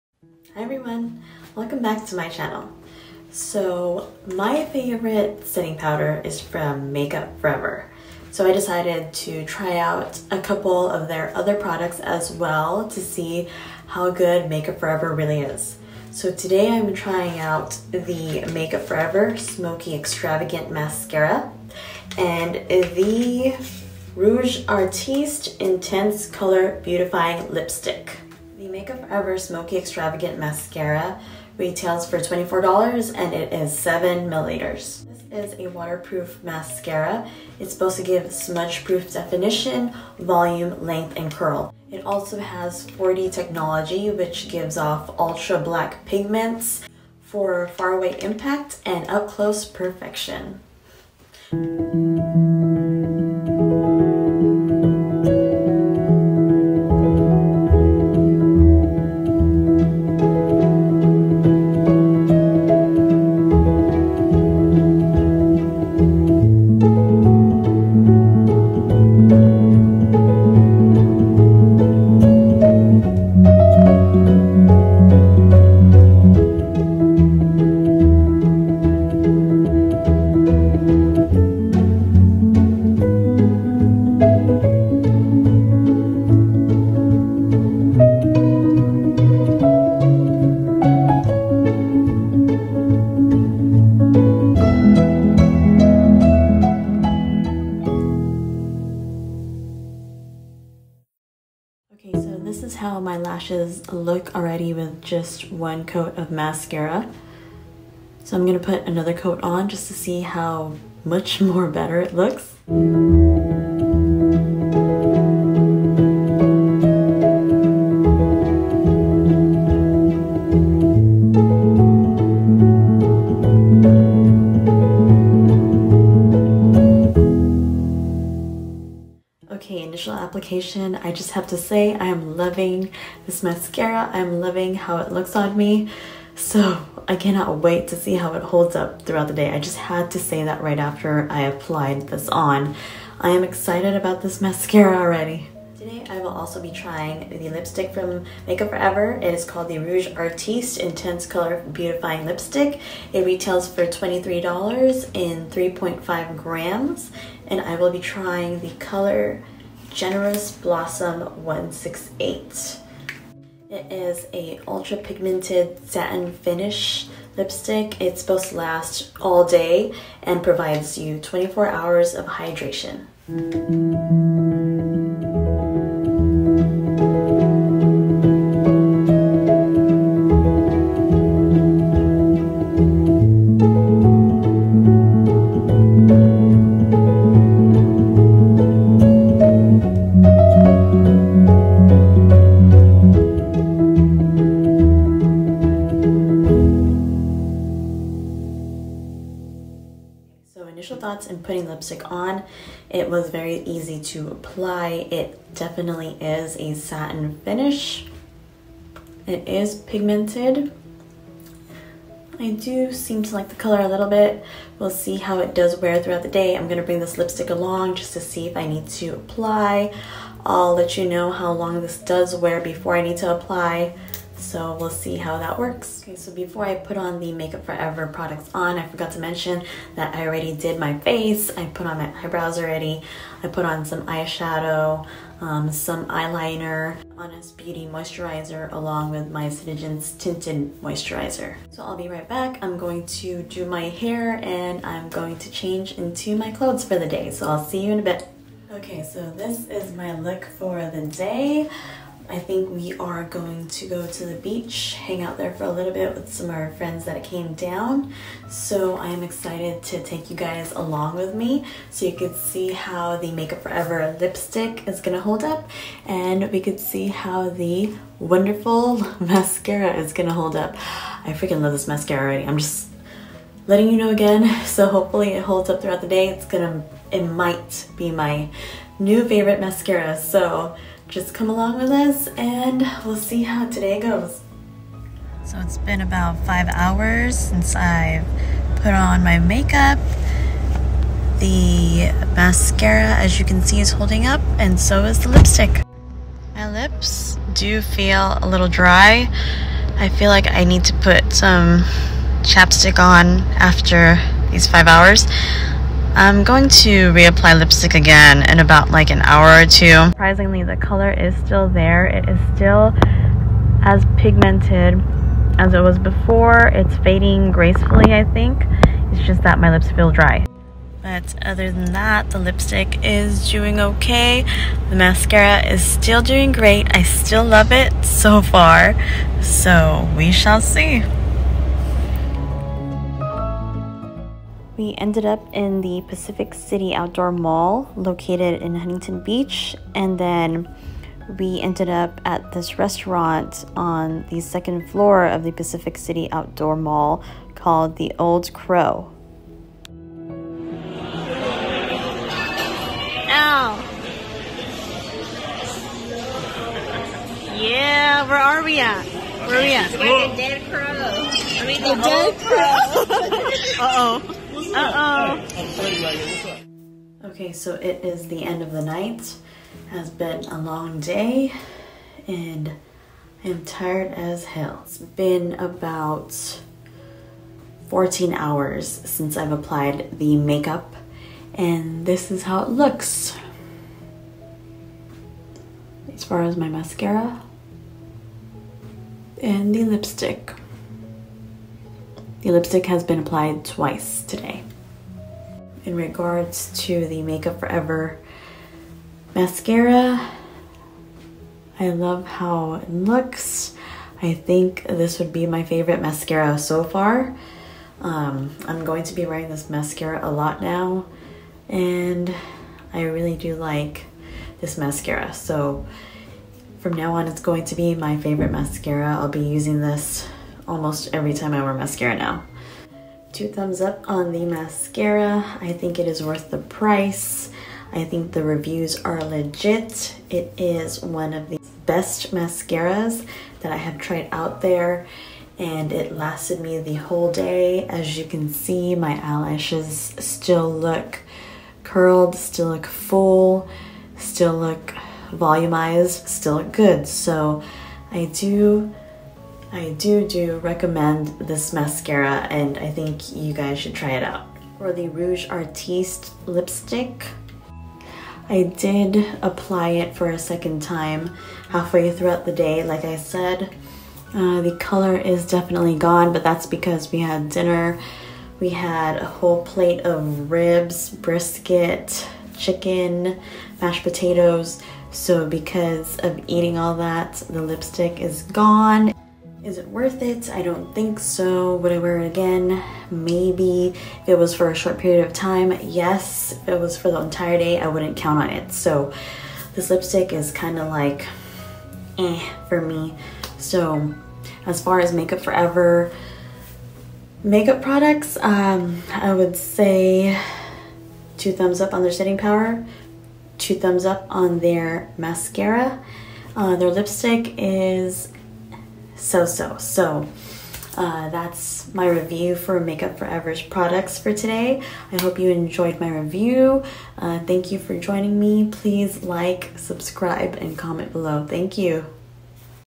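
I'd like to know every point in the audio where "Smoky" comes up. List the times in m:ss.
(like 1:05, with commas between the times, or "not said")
0:19, 0:29.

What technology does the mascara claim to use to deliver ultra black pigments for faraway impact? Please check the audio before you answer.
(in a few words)
4D technology.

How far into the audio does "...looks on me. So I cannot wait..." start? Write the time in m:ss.
2:15.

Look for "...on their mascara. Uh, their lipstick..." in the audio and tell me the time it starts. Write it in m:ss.
8:24.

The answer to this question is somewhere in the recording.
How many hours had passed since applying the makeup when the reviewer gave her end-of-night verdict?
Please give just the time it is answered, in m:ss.
6:17.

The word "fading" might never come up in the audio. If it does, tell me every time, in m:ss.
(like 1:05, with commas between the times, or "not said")
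5:16.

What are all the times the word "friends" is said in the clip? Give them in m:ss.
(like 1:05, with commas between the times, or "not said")
4:16.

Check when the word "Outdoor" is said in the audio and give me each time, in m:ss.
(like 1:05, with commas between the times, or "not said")
5:36, 5:46.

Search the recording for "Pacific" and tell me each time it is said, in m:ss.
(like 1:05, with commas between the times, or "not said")
5:36, 5:45.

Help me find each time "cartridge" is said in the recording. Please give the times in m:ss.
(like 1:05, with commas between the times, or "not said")
not said.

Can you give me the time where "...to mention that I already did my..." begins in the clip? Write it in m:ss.
3:49.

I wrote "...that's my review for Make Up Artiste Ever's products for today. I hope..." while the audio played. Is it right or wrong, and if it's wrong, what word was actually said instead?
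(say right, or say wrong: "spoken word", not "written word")
wrong: "For", not "Artiste".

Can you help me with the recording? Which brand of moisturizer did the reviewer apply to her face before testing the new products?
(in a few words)
Honest Beauty.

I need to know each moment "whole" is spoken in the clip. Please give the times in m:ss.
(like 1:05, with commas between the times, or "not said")
7:16, 7:49.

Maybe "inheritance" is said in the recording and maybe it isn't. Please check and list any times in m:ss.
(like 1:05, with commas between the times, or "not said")
not said.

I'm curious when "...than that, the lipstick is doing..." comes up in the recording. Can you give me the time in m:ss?
5:21.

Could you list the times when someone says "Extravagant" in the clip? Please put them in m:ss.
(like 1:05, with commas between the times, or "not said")
0:19, 0:29.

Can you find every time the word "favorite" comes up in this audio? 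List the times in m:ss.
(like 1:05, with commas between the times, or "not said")
0:04, 4:39, 6:45, 6:58.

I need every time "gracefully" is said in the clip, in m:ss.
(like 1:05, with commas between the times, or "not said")
5:17.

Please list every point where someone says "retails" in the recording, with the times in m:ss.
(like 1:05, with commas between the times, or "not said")
0:31, 2:33.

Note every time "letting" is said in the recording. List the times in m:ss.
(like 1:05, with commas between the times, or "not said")
4:33.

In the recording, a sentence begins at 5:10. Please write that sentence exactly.
Surprisingly, the color is still there.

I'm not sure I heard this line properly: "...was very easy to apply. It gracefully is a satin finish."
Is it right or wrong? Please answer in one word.
wrong.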